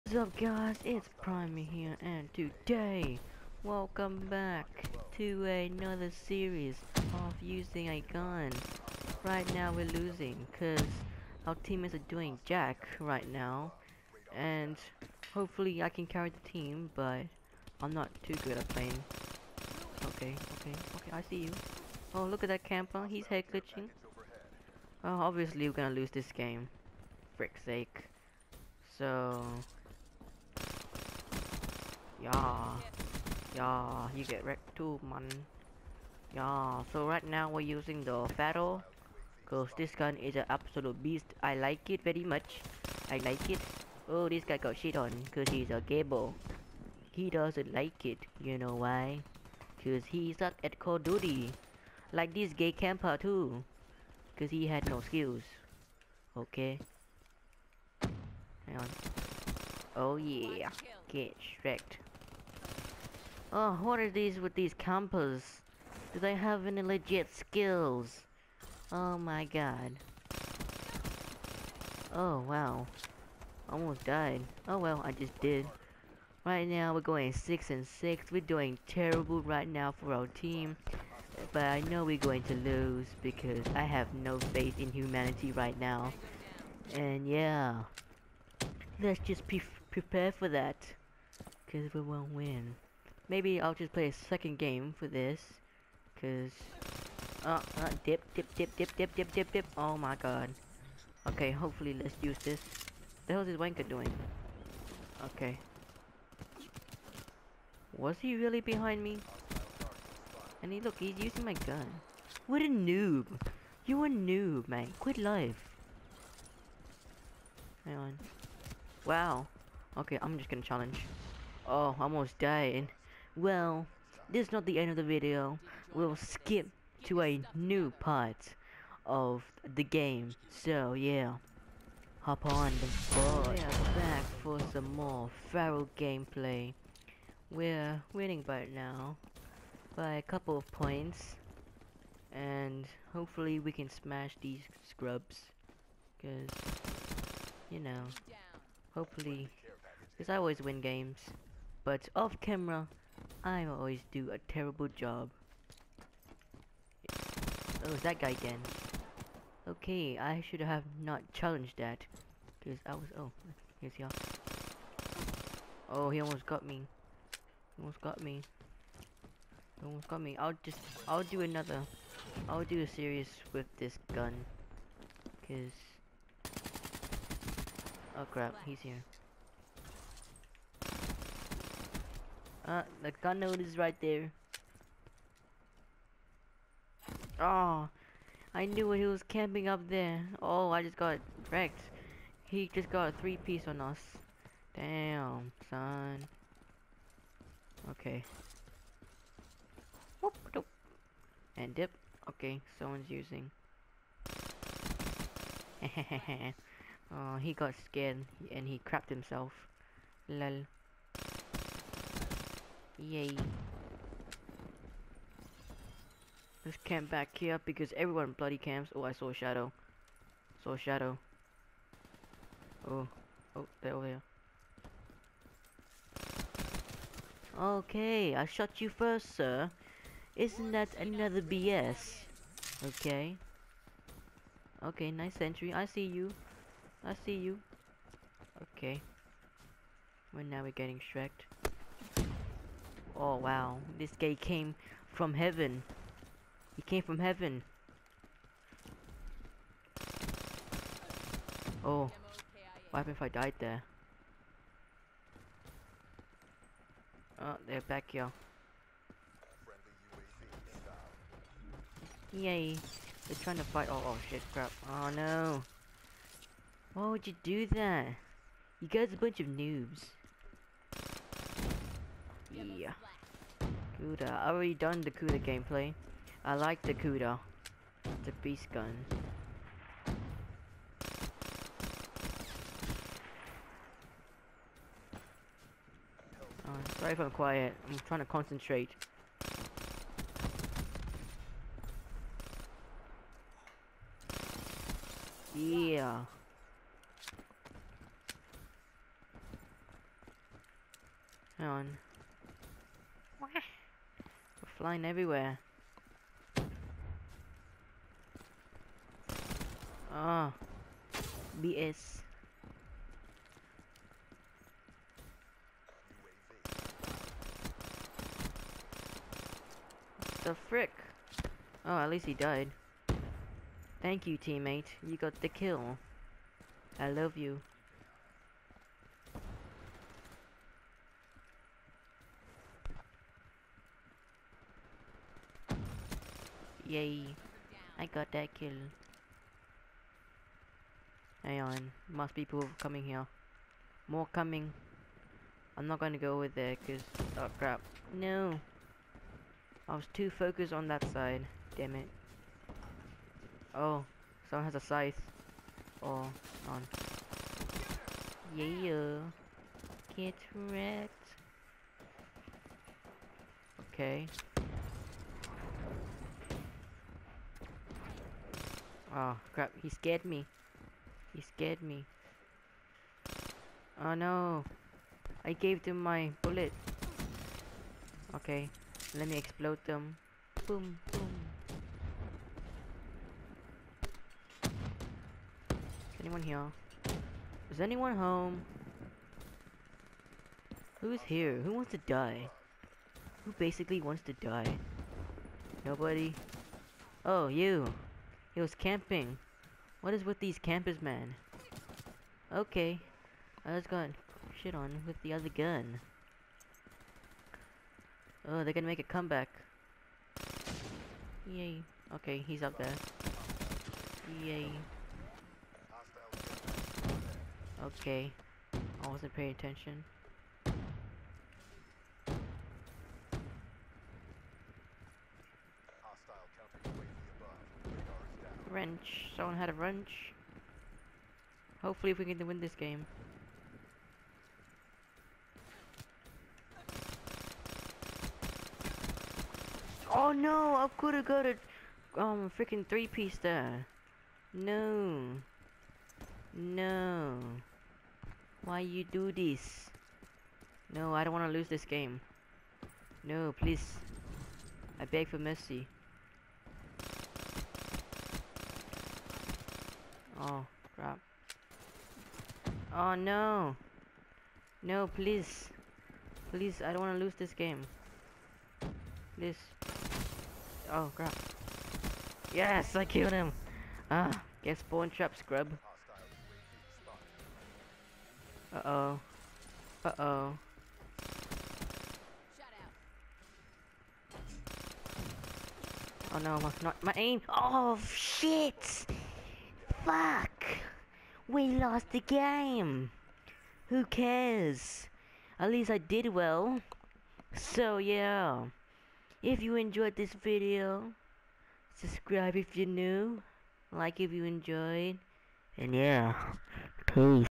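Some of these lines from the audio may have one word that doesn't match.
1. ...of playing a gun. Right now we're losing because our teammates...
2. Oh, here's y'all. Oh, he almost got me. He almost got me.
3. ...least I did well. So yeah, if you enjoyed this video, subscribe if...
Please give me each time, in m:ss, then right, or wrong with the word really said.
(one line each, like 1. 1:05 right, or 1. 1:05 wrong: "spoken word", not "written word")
1. 0:07 wrong: "using", not "playing"
2. 2:43 right
3. 8:15 right.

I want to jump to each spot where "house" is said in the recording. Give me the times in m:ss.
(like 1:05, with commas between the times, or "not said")
not said.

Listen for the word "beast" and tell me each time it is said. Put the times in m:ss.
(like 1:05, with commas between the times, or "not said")
0:41, 4:38.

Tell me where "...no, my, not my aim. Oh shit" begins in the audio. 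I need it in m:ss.
8:06.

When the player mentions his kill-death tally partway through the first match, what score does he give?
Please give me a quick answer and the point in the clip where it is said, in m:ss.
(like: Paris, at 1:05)
6 and 6, at 1:17.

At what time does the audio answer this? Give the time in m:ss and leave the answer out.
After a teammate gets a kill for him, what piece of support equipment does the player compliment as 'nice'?
3:55.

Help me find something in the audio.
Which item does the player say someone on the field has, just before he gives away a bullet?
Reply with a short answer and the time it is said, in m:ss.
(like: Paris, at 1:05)
scythe, at 5:54.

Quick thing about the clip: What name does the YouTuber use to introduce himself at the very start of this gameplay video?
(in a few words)
Primey.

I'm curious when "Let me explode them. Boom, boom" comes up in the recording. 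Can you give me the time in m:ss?
6:19.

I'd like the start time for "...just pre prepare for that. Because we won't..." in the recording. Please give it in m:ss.
1:29.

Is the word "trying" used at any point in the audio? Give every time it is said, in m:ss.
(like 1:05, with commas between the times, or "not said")
4:23, 4:48.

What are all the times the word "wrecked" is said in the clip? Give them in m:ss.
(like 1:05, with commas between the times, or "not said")
0:34, 1:01, 3:11, 6:00.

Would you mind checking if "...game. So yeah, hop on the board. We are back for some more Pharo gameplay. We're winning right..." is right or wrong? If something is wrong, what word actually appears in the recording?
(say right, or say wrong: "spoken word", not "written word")
right.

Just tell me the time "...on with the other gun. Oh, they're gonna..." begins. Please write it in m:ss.
6:44.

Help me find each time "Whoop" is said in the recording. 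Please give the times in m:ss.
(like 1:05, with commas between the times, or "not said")
3:20.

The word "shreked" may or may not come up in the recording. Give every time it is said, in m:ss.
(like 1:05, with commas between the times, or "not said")
4:01.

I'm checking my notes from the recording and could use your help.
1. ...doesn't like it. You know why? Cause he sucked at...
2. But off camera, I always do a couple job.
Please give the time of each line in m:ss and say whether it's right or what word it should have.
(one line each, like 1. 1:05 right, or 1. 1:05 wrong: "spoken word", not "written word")
1. 0:47 right
2. 2:31 wrong: "terrible", not "couple".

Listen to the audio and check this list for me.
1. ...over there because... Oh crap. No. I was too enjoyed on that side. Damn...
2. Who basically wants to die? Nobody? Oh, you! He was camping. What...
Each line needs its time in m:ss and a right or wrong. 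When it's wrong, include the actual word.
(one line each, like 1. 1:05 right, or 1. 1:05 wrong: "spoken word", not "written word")
1. 5:46 wrong: "focused", not "enjoyed"
2. 6:33 right.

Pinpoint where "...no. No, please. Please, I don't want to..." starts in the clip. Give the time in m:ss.
7:43.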